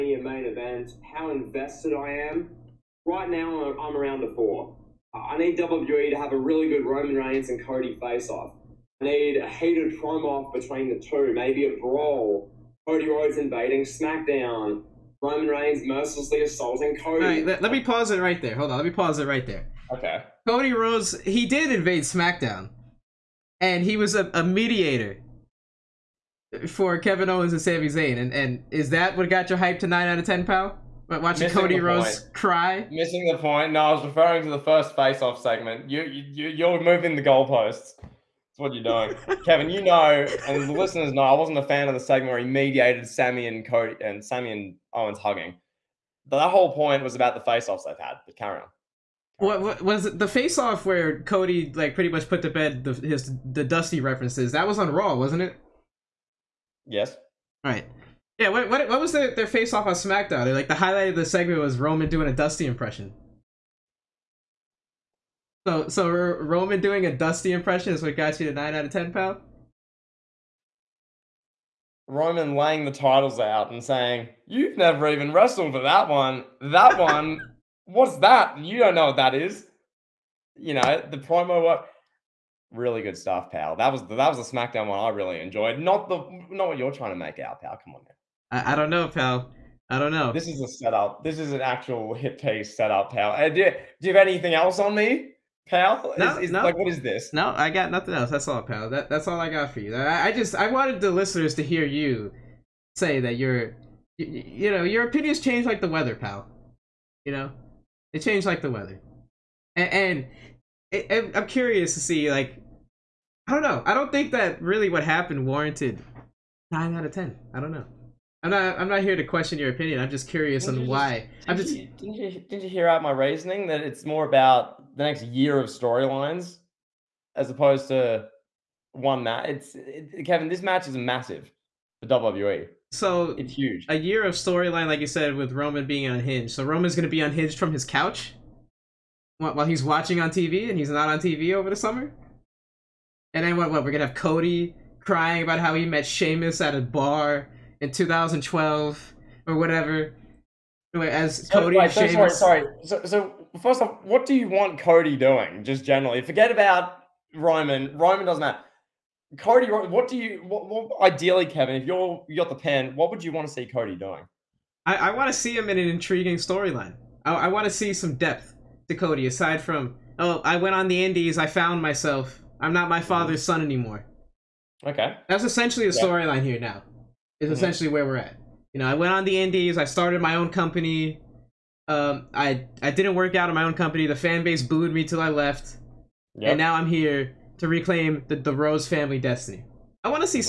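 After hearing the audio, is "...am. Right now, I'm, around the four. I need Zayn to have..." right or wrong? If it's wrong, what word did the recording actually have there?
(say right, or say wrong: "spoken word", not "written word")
wrong: "WWE", not "Zayn".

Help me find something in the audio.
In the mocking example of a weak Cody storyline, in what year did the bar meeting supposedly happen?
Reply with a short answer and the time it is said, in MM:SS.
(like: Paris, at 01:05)
2012, at 02:27.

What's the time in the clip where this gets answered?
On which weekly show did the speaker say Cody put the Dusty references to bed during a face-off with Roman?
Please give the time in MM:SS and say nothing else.
00:54.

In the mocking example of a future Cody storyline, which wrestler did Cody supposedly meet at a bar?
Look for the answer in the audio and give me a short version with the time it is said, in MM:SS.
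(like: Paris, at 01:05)
Sheamus, at 02:26.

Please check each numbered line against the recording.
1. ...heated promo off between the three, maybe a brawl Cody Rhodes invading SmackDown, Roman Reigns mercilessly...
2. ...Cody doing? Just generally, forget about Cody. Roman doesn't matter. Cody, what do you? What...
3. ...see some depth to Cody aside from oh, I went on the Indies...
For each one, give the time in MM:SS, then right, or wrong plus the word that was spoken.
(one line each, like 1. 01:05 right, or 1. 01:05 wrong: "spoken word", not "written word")
1. 00:09 wrong: "two", not "three"
2. 02:34 wrong: "Roman", not "Cody"
3. 02:47 right.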